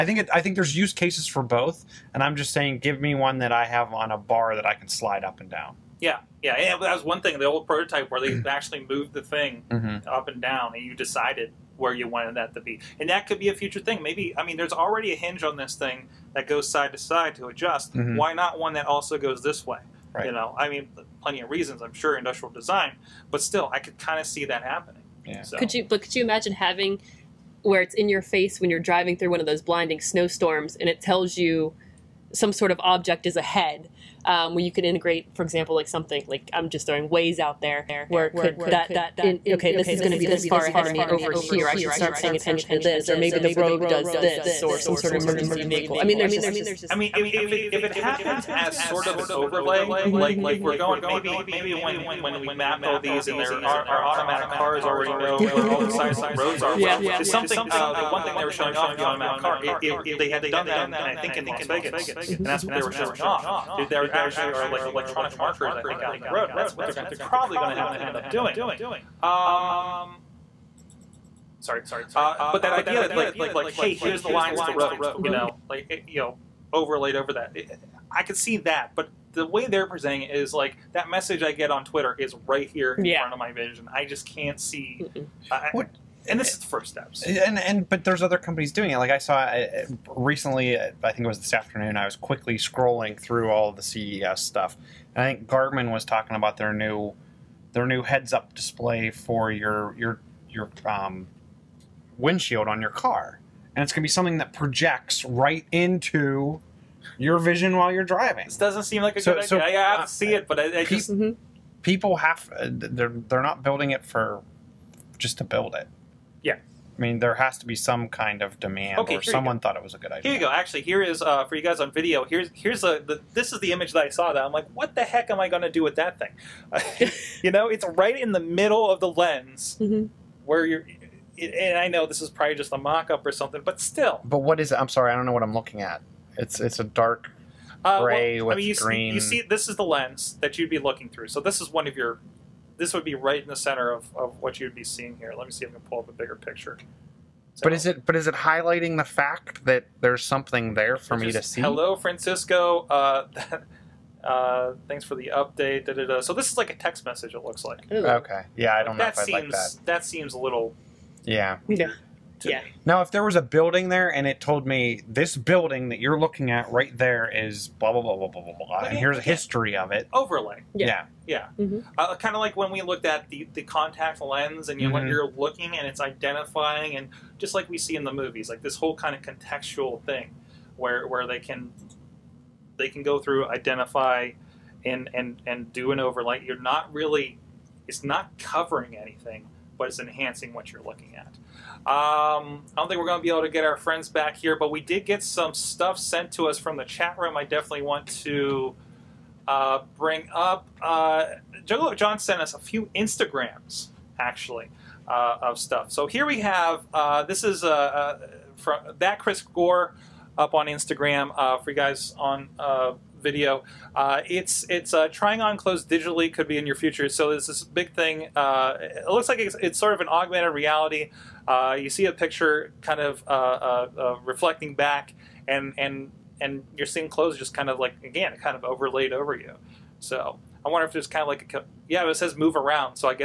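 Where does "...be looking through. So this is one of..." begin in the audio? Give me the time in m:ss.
2:20.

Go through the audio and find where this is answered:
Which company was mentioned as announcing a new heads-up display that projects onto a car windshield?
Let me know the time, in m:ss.
1:35.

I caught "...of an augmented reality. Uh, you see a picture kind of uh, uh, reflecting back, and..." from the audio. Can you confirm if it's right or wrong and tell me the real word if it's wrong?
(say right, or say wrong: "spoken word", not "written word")
right.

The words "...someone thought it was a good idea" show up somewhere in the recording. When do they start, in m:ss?
1:59.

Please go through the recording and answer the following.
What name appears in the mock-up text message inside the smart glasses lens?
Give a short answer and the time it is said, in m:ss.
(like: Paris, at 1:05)
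Francisco, at 2:31.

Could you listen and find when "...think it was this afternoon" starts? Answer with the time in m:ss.
1:31.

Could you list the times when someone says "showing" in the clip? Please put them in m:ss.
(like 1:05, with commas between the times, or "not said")
0:58, 1:02.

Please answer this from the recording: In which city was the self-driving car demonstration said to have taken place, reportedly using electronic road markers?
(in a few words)
Las Vegas.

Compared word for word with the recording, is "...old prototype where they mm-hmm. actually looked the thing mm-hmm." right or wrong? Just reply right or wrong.
wrong.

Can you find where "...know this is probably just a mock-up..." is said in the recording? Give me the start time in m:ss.
2:11.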